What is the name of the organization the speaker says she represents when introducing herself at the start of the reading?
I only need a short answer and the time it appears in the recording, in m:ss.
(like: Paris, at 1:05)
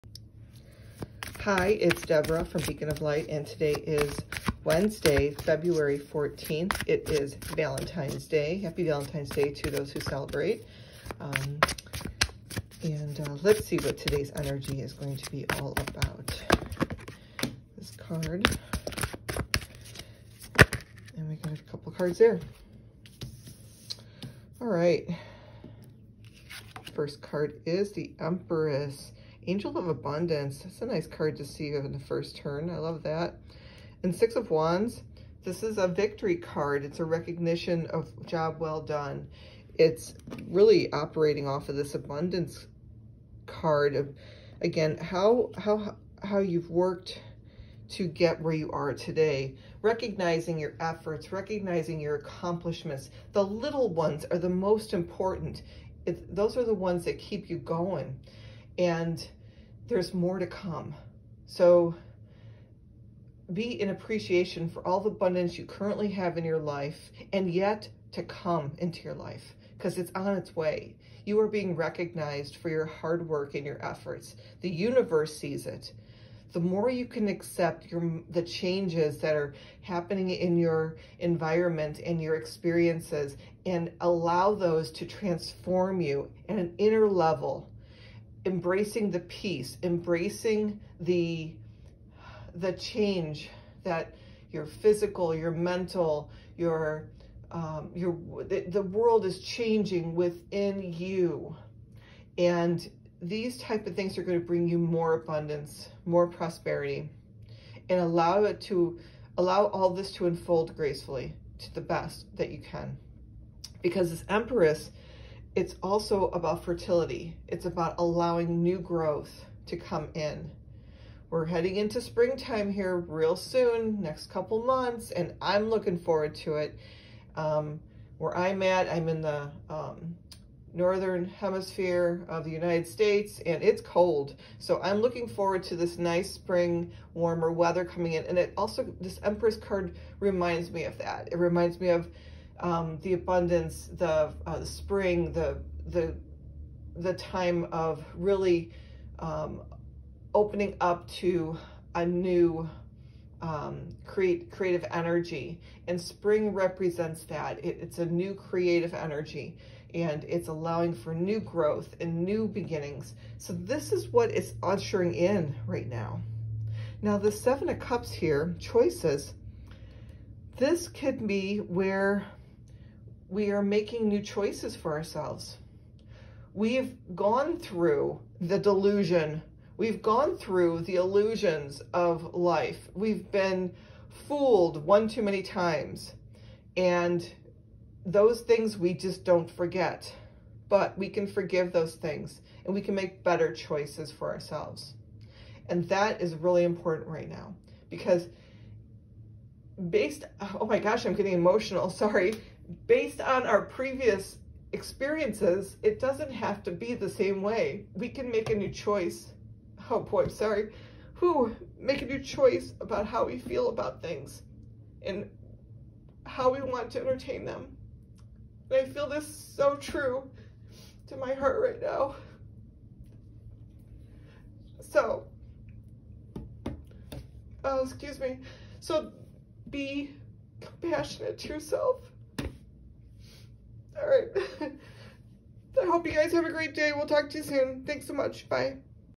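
Beacon of Light, at 0:02.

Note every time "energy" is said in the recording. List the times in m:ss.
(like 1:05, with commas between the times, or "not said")
0:14, 2:34, 2:38.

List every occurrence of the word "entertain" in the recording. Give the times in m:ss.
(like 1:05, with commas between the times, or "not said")
3:36.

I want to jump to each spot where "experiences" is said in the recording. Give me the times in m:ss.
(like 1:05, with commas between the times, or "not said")
1:22, 3:24.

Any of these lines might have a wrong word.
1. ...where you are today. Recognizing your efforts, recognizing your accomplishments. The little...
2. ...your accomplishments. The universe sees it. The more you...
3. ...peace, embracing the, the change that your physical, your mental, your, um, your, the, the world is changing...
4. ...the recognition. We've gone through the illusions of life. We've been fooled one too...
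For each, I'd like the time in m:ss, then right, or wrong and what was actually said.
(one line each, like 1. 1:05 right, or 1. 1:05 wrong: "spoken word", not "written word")
1. 0:48 right
2. 1:13 wrong: "efforts", not "accomplishments"
3. 1:29 right
4. 2:58 wrong: "delusion", not "recognition".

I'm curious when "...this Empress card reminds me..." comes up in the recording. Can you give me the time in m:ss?
2:19.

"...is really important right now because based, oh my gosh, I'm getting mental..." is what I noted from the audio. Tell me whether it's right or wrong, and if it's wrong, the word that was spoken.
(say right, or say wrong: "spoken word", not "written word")
wrong: "emotional", not "mental".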